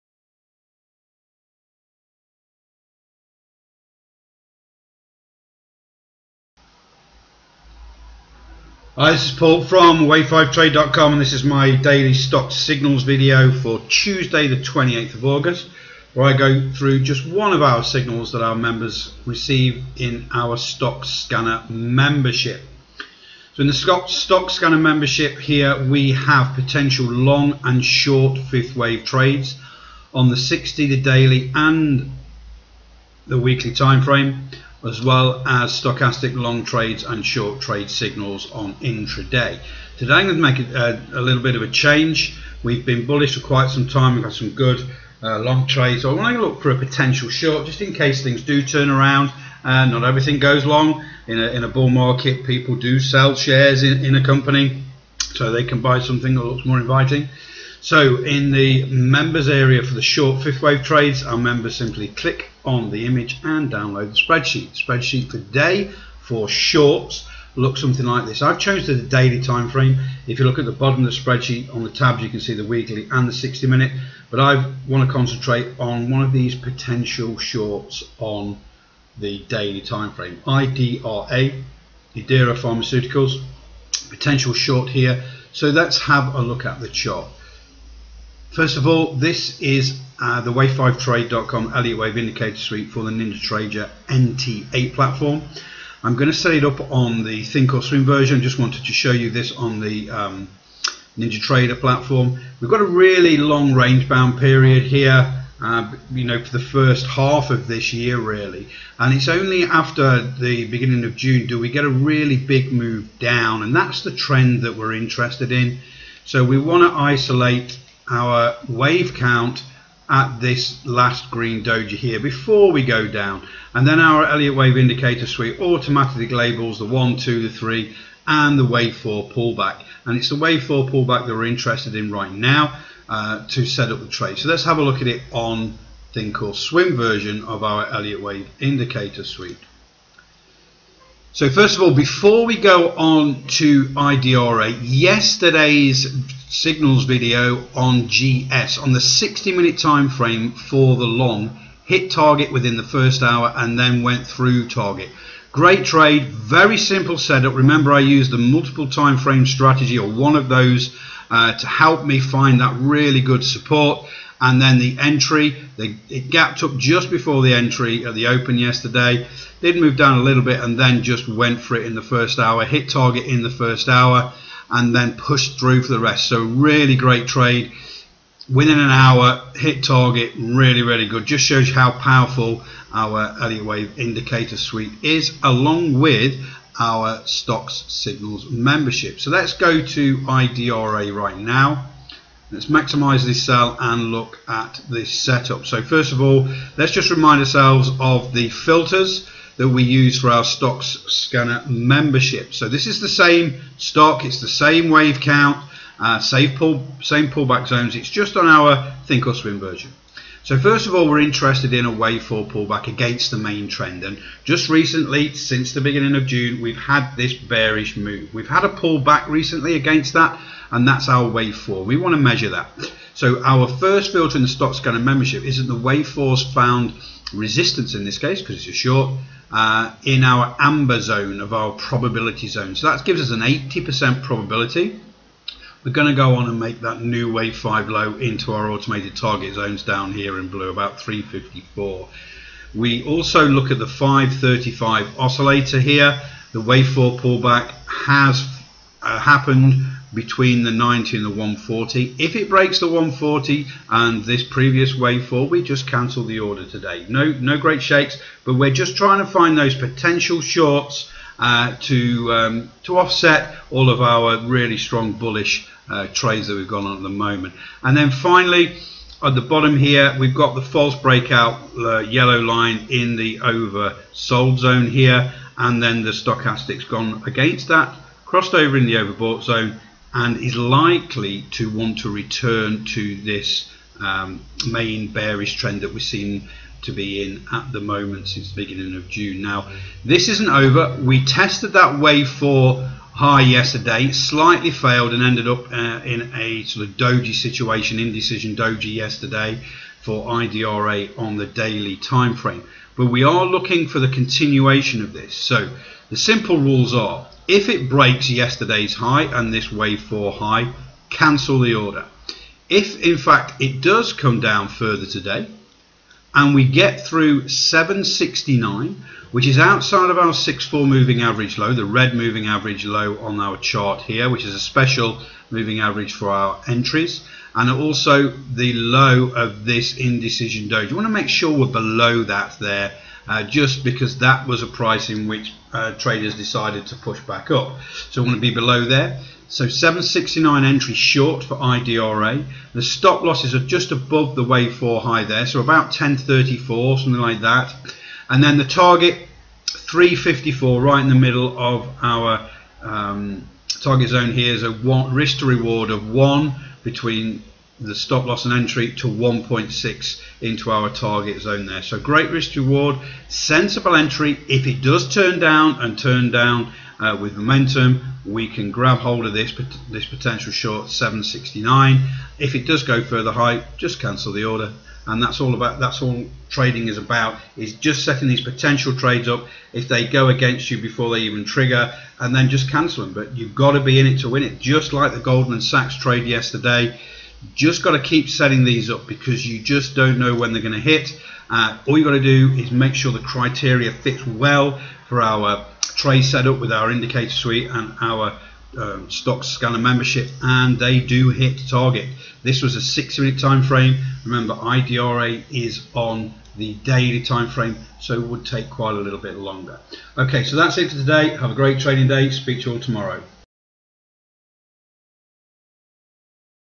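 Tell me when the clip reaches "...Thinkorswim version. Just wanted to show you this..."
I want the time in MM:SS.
01:37.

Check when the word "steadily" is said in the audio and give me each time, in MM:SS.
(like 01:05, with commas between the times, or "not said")
not said.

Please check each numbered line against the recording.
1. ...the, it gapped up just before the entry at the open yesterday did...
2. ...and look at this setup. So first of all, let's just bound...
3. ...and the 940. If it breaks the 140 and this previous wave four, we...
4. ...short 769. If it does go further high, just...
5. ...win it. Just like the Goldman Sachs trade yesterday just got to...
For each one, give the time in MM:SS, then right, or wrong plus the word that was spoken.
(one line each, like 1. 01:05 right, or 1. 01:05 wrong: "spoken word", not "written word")
1. 02:45 right
2. 03:13 wrong: "remind", not "bound"
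3. 04:11 wrong: "140", not "940"
4. 06:10 right
5. 06:24 right.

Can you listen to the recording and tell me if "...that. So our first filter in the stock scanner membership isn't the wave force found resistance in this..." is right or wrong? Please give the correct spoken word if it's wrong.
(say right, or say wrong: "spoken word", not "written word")
right.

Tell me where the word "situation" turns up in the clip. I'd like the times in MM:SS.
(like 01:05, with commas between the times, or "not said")
04:57.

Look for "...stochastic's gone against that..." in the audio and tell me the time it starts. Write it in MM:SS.
04:36.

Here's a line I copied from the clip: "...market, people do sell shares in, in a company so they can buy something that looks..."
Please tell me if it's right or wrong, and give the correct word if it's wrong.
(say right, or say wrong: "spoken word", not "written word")
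right.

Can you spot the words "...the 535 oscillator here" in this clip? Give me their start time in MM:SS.
04:03.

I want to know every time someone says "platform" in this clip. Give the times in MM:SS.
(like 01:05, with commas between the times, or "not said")
01:34, 01:41.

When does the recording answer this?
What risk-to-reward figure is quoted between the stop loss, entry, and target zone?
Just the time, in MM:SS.
05:59.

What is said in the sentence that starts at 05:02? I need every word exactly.
But we are looking for the continuation of this.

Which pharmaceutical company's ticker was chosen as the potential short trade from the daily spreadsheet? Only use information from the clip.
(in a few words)
Idera Pharmaceuticals.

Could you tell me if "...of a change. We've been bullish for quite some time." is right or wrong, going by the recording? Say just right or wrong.
right.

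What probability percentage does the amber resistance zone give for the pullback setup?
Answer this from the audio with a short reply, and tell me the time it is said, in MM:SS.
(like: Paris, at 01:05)
80%, at 03:53.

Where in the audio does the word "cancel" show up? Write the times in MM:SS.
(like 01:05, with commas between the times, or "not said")
04:15, 05:11, 06:13, 06:22.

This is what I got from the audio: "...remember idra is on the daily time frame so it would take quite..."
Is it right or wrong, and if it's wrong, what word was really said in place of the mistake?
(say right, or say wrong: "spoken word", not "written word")
right.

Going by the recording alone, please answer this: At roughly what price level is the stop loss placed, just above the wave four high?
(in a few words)
1034.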